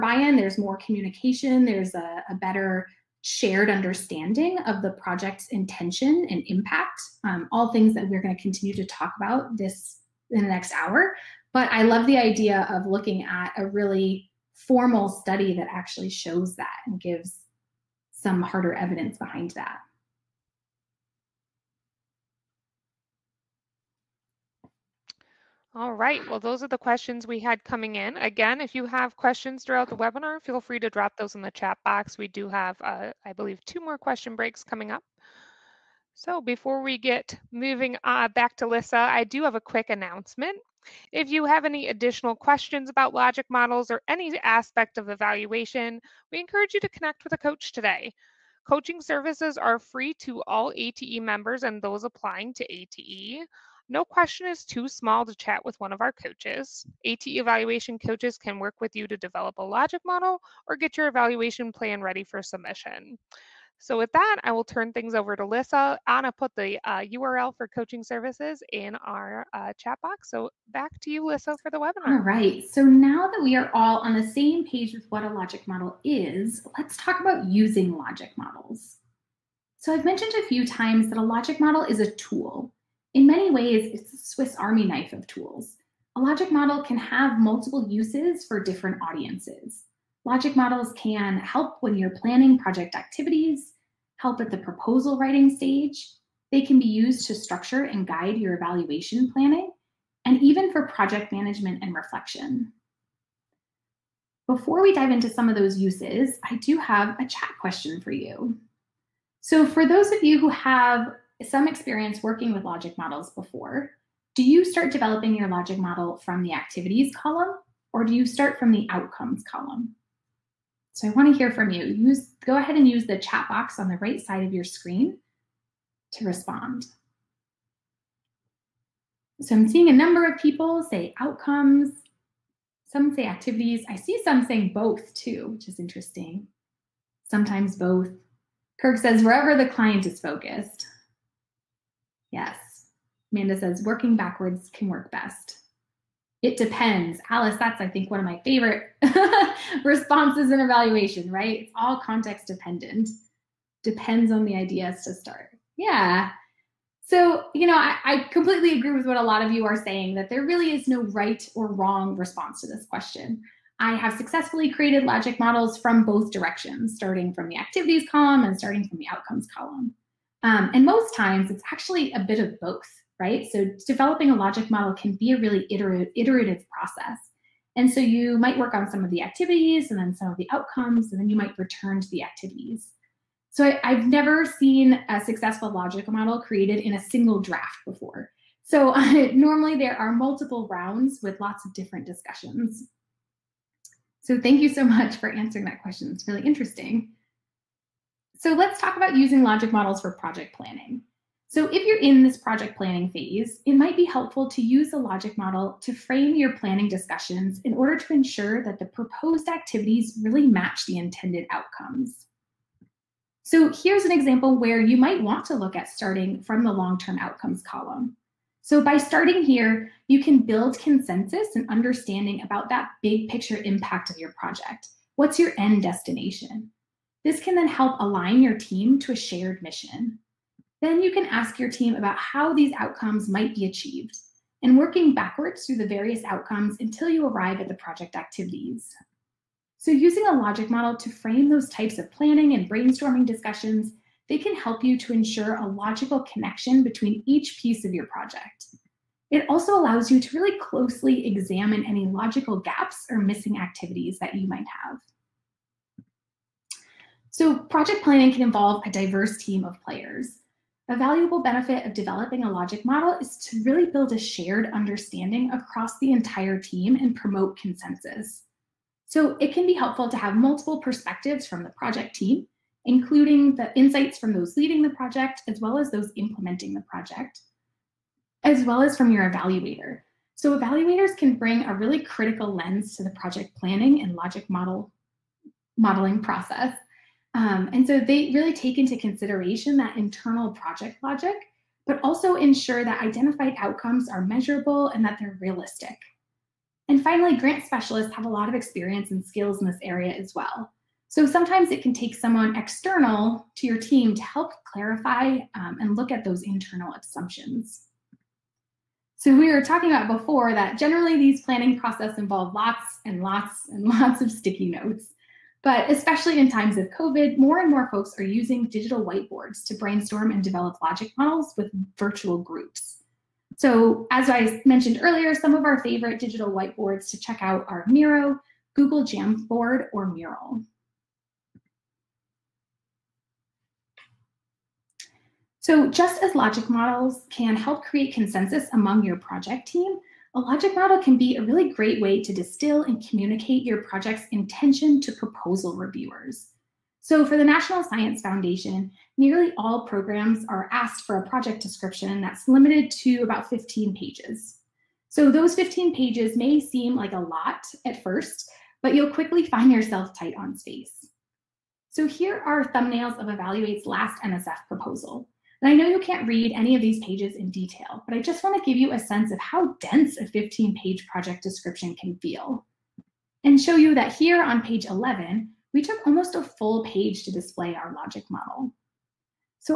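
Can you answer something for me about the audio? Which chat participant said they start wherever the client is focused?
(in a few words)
Kirk.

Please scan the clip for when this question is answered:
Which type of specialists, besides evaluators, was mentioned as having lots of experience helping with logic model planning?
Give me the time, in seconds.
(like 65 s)
297 s.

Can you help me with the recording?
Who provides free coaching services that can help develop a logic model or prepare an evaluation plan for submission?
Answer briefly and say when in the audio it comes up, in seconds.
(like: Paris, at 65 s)
ATE evaluation coaches, at 57 s.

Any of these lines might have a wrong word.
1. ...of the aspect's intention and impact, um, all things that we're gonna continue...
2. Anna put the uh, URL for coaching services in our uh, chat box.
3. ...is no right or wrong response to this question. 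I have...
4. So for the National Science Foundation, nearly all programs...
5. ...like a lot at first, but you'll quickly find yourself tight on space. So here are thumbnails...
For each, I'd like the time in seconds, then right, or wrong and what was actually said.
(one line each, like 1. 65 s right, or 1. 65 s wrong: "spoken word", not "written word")
1. 4 s wrong: "project", not "aspect"
2. 66 s right
3. 160 s right
4. 347 s right
5. 356 s right.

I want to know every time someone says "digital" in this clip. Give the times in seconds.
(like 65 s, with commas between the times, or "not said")
318 s, 326 s.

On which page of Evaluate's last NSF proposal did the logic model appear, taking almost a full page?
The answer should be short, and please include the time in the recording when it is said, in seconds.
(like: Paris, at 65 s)
11, at 374 s.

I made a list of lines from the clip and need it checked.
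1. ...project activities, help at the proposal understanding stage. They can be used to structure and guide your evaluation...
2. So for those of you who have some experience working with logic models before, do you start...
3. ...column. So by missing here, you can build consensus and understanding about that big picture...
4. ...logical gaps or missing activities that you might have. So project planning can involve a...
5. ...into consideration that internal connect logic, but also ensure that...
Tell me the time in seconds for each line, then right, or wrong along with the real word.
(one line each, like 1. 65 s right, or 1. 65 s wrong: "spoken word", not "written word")
1. 92 s wrong: "writing", not "understanding"
2. 109 s right
3. 217 s wrong: "starting", not "missing"
4. 252 s right
5. 288 s wrong: "project", not "connect".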